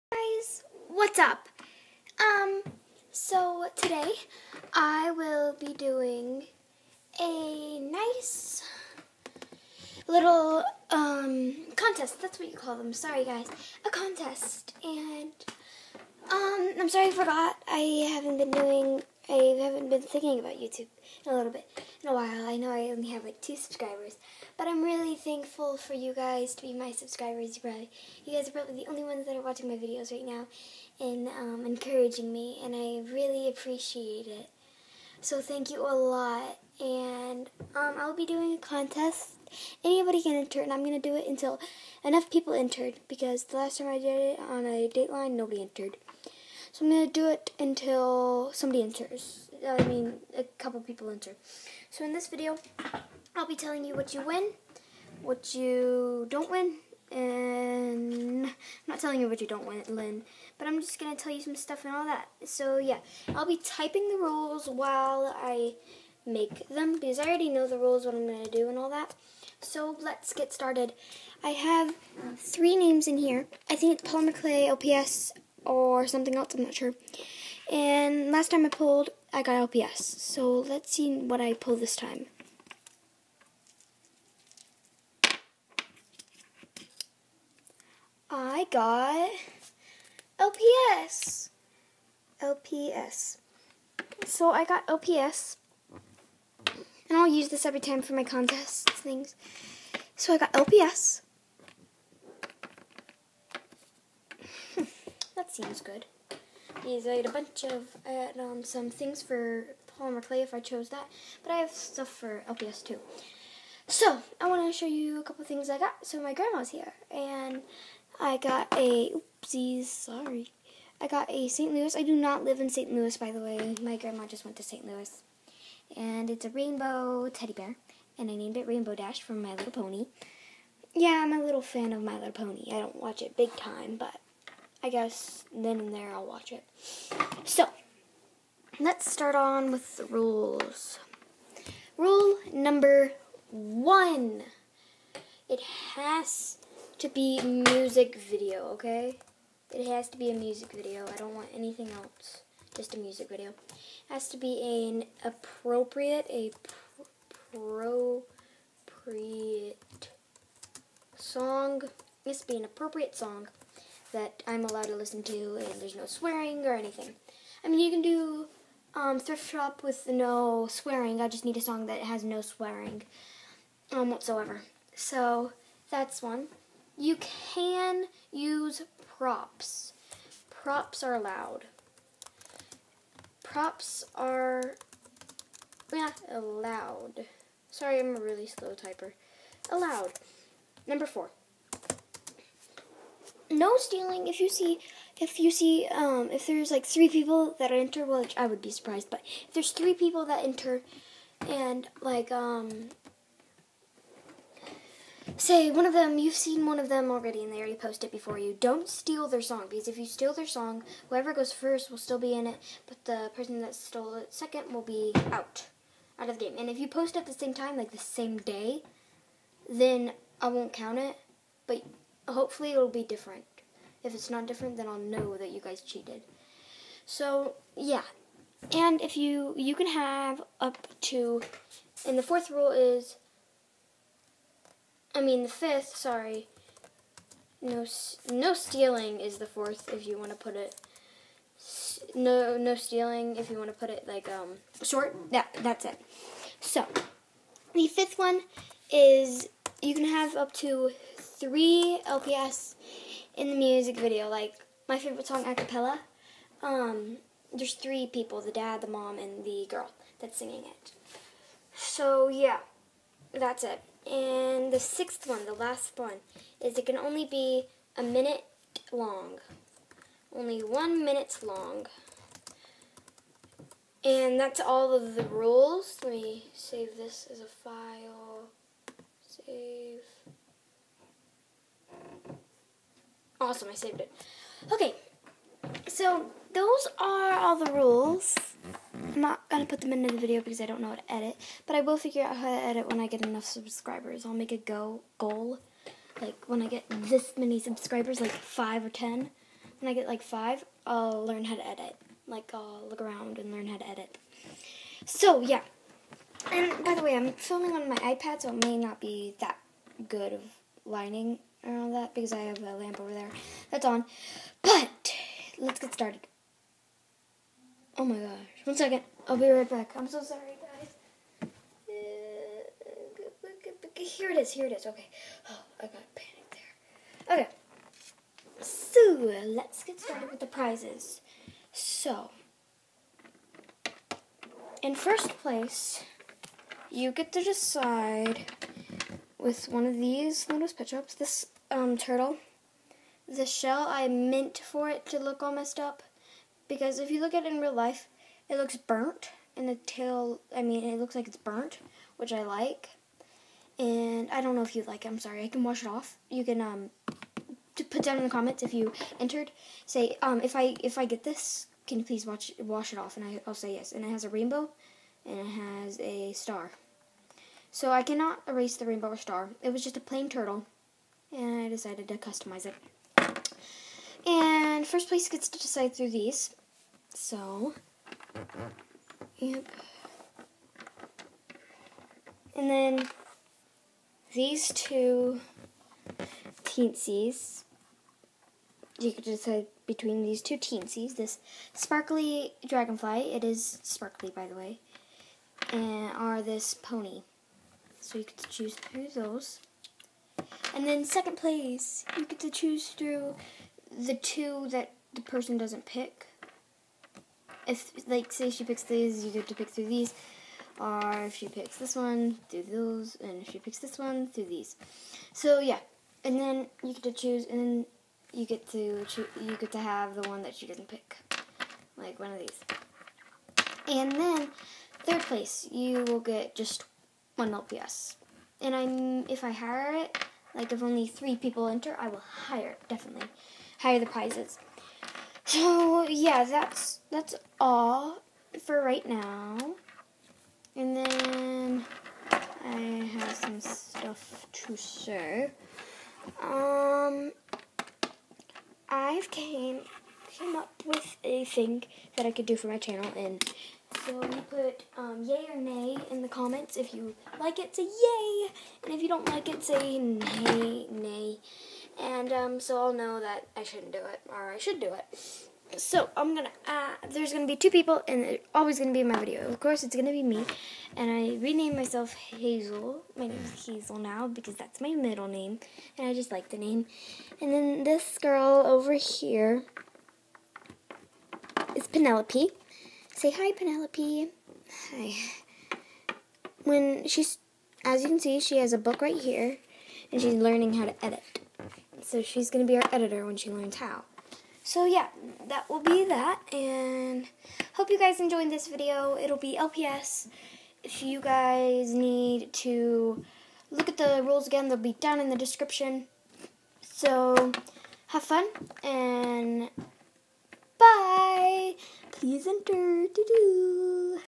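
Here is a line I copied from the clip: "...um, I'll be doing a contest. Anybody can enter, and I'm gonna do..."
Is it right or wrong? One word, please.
right.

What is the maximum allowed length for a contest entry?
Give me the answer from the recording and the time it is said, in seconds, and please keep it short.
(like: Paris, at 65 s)
1 minute, at 270 s.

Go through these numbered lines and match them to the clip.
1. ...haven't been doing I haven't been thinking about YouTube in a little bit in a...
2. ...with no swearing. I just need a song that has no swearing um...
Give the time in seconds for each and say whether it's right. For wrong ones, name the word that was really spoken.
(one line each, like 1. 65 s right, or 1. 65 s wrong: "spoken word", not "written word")
1. 18 s right
2. 169 s right.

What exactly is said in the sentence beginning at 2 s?
Um, so today I will be doing a nice little um contest.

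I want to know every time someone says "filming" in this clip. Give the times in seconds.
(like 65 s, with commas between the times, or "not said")
307 s.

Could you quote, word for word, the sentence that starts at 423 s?
And then third place, you will get just one LPS.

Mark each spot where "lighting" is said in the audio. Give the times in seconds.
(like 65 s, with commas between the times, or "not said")
310 s.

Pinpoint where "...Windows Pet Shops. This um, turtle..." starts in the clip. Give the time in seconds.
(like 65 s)
340 s.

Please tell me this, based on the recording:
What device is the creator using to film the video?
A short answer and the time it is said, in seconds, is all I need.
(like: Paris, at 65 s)
iPad, at 307 s.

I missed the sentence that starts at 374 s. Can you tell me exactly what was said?
And first place gets to decide through these.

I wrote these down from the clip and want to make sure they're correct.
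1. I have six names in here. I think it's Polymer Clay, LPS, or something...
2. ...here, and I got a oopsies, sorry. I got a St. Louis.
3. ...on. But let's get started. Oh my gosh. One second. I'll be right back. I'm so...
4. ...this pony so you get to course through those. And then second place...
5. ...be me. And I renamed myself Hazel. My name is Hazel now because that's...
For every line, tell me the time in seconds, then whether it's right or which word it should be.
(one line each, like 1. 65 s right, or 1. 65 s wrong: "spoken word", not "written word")
1. 71 s wrong: "three", not "six"
2. 116 s right
3. 313 s right
4. 396 s wrong: "choose", not "course"
5. 470 s right.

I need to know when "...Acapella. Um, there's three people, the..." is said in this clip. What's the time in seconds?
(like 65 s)
255 s.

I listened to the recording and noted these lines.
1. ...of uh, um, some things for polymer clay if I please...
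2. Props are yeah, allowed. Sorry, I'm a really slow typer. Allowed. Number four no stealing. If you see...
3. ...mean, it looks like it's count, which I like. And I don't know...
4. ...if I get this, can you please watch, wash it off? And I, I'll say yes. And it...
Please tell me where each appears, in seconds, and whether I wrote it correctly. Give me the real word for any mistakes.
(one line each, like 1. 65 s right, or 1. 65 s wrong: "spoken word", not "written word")
1. 107 s wrong: "chose", not "please"
2. 183 s right
3. 350 s wrong: "burnt", not "count"
4. 360 s right.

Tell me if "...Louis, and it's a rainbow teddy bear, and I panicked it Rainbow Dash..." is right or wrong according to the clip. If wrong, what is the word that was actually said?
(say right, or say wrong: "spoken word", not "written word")
wrong: "named", not "panicked".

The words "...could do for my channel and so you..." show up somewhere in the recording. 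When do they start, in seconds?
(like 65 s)
452 s.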